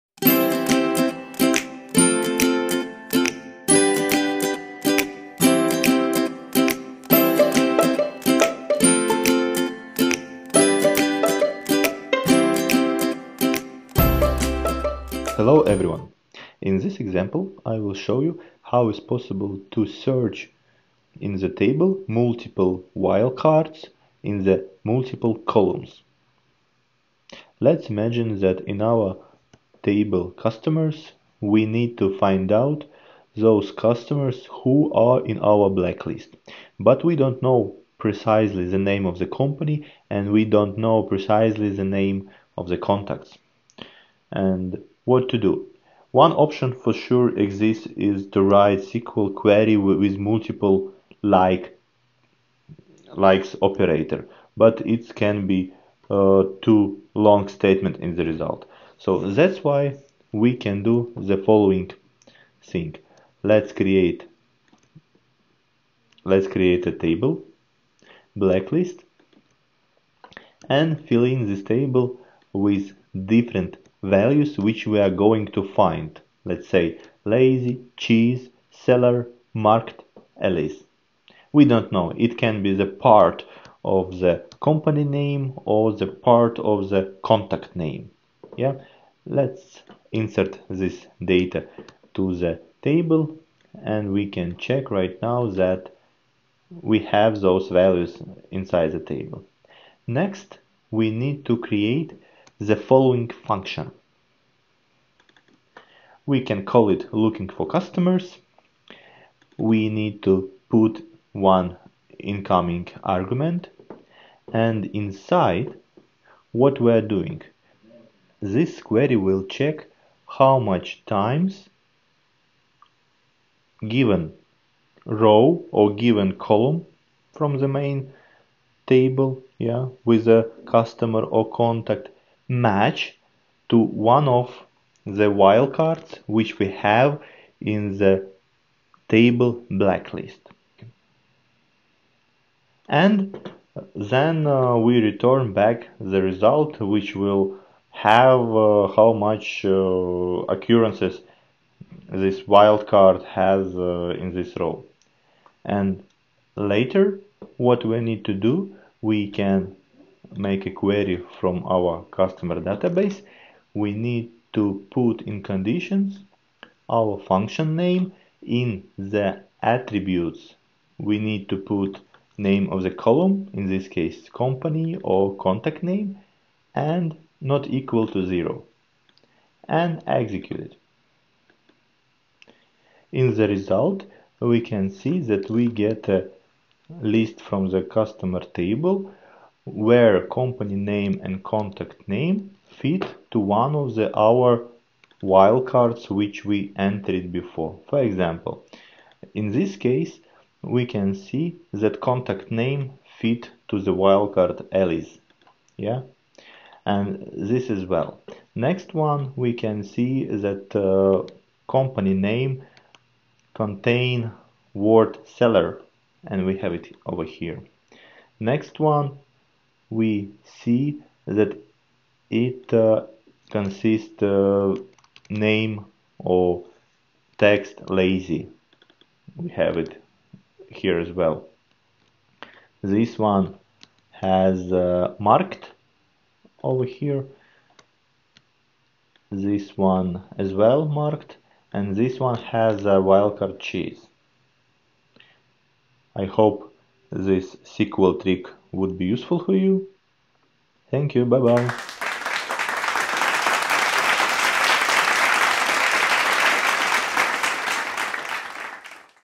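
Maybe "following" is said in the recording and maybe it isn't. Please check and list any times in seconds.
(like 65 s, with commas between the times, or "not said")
61 s, 102 s.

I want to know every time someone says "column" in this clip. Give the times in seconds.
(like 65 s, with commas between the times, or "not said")
25 s, 126 s, 172 s.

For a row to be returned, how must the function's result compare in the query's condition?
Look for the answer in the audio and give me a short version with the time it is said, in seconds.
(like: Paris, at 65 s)
not equal to zero, at 177 s.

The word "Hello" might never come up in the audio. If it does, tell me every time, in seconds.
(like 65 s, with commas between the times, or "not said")
15 s.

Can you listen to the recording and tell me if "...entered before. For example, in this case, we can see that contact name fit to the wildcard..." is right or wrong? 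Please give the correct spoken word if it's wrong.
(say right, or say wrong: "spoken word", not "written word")
right.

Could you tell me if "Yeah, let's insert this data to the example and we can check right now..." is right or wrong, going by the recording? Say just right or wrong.
wrong.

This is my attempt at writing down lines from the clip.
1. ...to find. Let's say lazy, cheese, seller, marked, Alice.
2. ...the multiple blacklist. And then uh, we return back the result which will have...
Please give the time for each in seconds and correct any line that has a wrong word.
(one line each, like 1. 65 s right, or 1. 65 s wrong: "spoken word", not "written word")
1. 75 s right
2. 137 s wrong: "table", not "multiple".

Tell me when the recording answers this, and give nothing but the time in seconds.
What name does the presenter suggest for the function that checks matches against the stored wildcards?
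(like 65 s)
107 s.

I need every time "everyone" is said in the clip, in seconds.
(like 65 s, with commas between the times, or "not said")
15 s.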